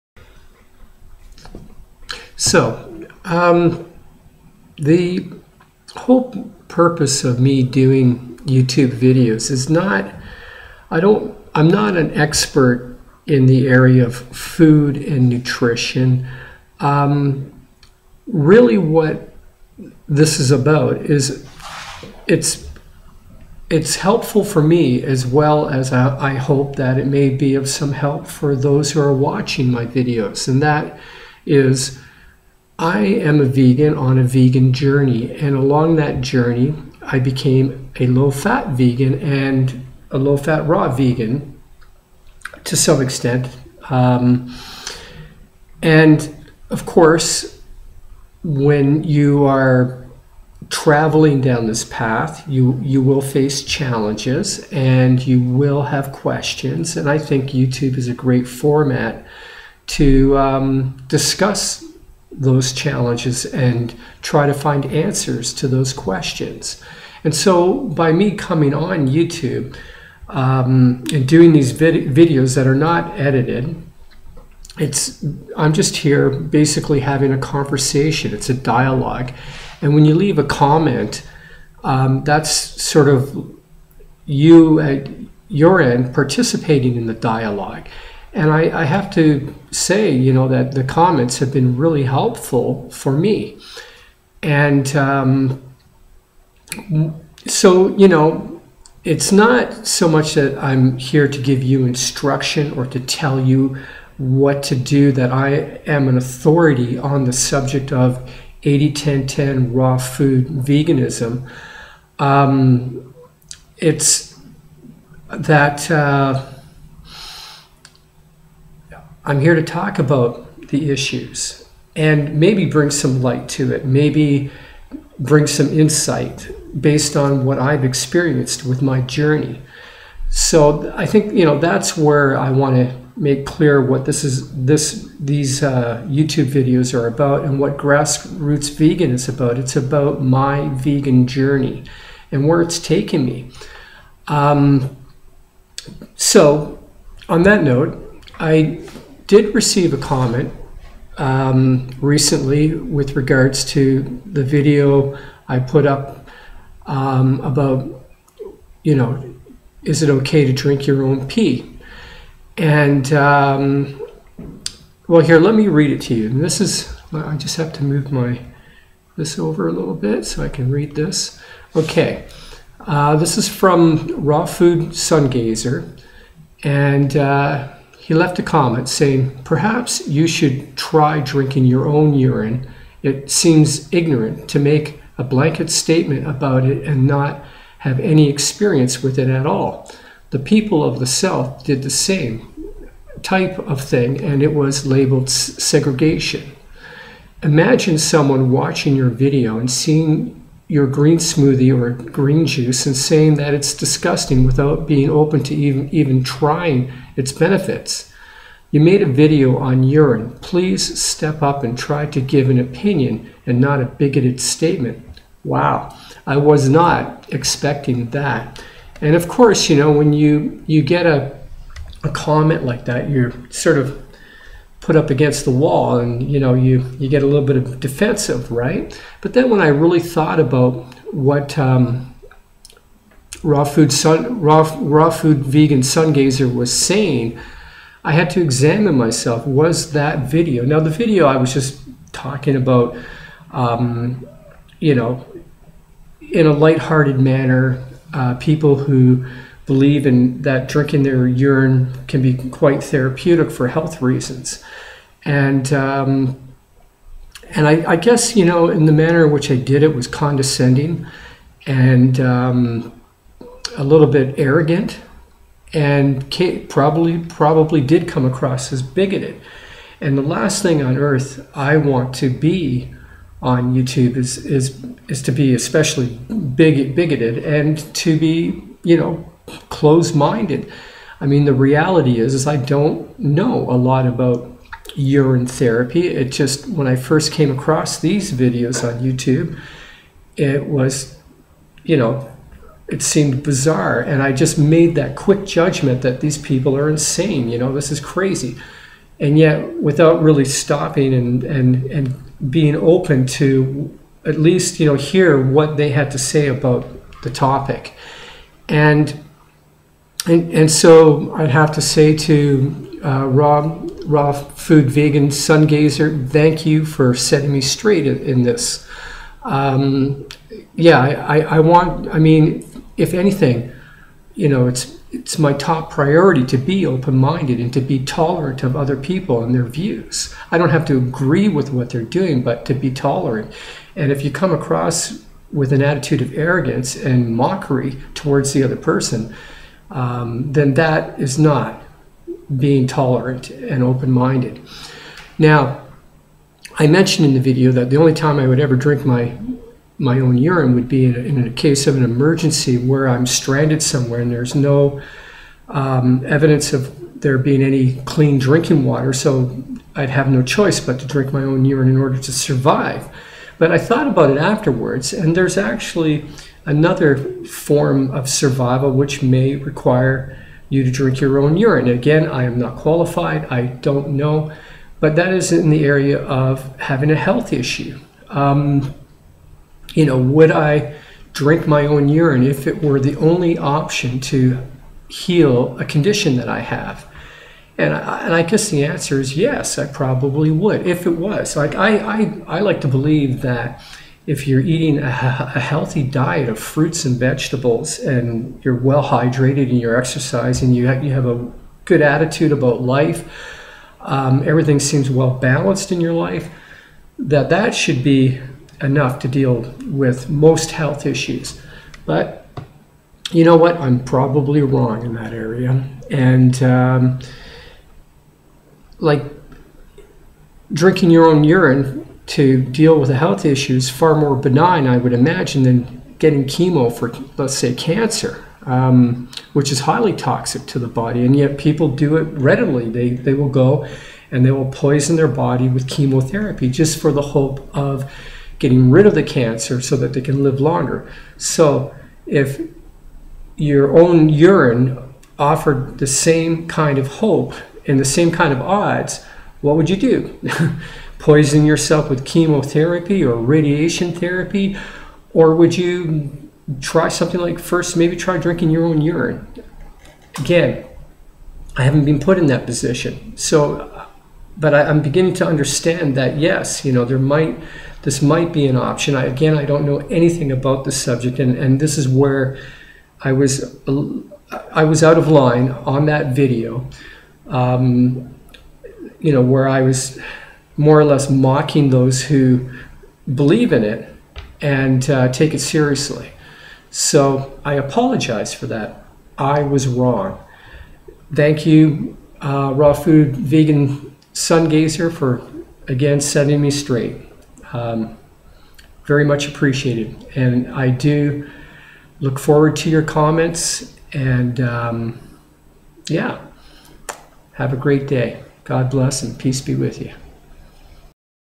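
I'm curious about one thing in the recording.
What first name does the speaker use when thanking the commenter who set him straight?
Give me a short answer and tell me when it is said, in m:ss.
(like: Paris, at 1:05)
Rob, at 5:13.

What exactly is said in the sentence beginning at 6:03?
But I thought about it afterwards, and there's actually another form of survival which may require you to drink your own urine.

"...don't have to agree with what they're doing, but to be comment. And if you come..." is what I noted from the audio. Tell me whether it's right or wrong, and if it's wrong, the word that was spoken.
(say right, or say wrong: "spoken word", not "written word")
wrong: "tolerant", not "comment".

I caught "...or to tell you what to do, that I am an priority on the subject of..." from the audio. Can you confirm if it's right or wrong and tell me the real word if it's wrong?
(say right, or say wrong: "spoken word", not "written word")
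wrong: "authority", not "priority".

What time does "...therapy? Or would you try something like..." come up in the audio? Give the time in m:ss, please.
7:34.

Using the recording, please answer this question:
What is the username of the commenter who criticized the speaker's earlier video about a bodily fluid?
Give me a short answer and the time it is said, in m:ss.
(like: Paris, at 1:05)
Raw Food Sungazer, at 2:54.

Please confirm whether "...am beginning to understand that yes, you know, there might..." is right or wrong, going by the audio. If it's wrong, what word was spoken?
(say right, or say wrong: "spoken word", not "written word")
right.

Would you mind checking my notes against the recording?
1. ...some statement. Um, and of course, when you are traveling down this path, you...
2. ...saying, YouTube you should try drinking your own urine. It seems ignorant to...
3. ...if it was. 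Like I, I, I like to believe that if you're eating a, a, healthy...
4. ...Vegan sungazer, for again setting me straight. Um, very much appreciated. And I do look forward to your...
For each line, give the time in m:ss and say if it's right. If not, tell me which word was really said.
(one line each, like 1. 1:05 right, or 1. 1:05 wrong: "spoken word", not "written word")
1. 0:42 wrong: "extent", not "statement"
2. 2:58 wrong: "Perhaps", not "YouTube"
3. 6:30 right
4. 8:13 right.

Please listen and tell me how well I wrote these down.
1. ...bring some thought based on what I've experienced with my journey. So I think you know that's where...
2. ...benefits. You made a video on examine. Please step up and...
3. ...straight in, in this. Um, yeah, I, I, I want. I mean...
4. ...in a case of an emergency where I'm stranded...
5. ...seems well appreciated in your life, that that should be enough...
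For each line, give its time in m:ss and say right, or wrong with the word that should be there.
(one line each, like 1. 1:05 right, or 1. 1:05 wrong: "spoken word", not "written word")
1. 2:05 wrong: "insight", not "thought"
2. 3:27 wrong: "urine", not "examine"
3. 5:17 right
4. 5:51 right
5. 6:44 wrong: "balanced", not "appreciated".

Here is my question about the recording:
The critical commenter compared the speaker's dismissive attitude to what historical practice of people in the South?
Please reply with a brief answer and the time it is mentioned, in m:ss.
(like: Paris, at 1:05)
segregation, at 3:15.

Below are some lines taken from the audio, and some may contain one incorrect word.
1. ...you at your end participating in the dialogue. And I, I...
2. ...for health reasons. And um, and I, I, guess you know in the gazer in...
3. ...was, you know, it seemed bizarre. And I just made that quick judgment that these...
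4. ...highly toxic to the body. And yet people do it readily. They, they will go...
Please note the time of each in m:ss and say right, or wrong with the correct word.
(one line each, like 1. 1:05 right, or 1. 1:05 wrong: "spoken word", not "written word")
1. 1:24 right
2. 4:13 wrong: "manner", not "gazer"
3. 4:50 right
4. 7:09 right.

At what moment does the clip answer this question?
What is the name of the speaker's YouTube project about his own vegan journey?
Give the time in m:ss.
2:17.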